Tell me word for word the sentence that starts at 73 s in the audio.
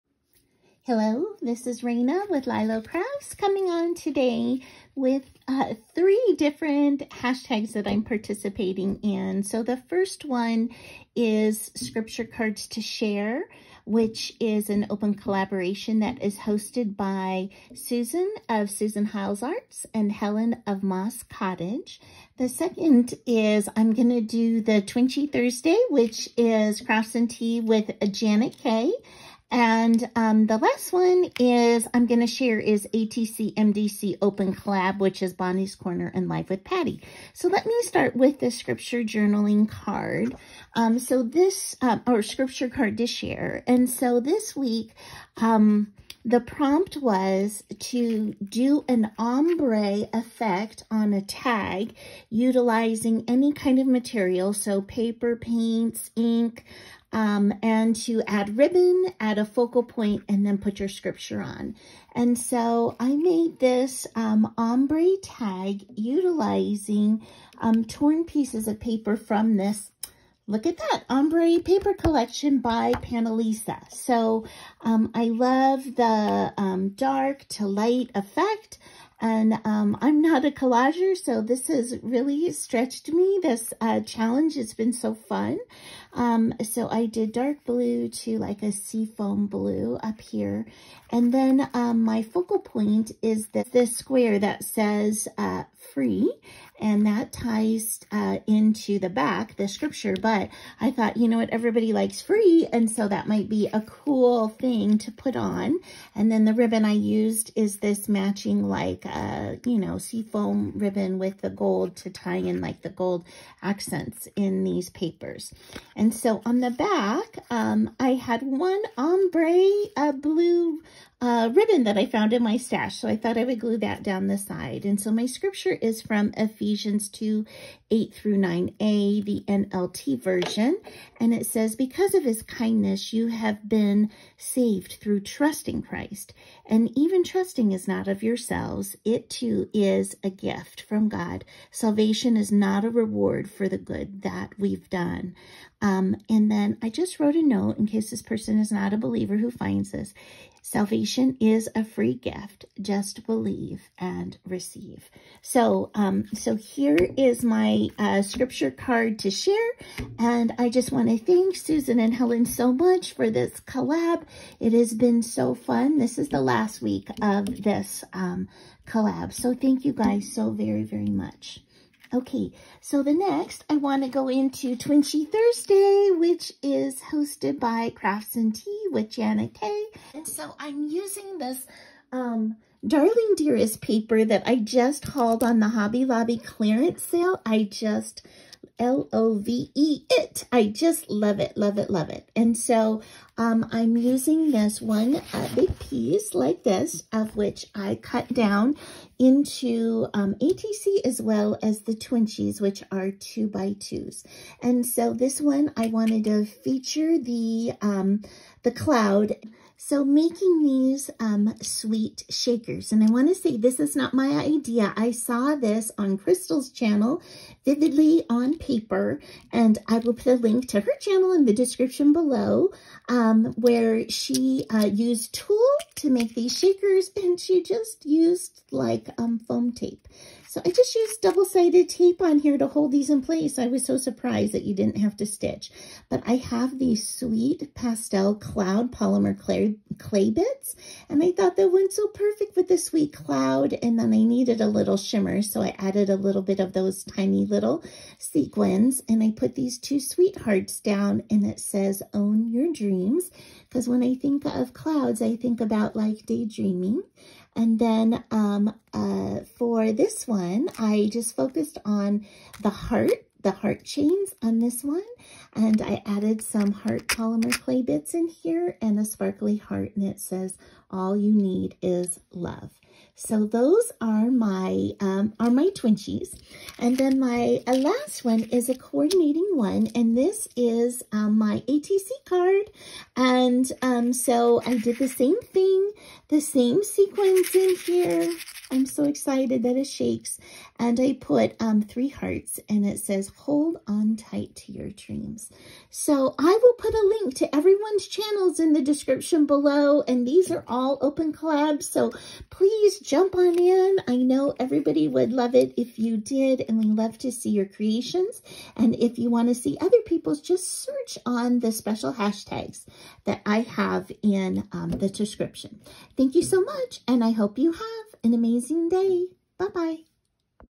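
So um, I love the um, dark to light effect and um, I'm not a collager, so this has really stretched me.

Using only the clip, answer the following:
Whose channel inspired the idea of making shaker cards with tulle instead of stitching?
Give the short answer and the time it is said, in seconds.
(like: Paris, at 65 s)
Krystal, at 216 s.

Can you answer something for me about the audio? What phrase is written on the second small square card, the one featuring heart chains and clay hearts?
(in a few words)
All you need is love.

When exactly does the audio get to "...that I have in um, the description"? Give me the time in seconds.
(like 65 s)
313 s.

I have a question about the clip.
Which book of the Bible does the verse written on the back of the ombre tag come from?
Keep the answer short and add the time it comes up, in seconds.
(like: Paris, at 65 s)
Ephesians, at 126 s.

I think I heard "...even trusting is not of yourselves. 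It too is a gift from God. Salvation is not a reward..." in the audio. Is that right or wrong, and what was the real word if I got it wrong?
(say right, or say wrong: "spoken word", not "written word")
right.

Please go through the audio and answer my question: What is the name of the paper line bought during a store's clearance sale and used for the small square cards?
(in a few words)
Darling Dearest.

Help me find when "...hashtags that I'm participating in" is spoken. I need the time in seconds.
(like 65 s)
7 s.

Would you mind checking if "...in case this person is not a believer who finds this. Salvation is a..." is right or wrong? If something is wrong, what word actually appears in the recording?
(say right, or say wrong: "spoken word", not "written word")
right.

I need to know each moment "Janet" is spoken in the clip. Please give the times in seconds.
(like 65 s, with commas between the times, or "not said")
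28 s, 179 s.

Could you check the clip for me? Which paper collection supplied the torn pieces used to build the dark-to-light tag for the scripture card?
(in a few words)
Look at That Ombre.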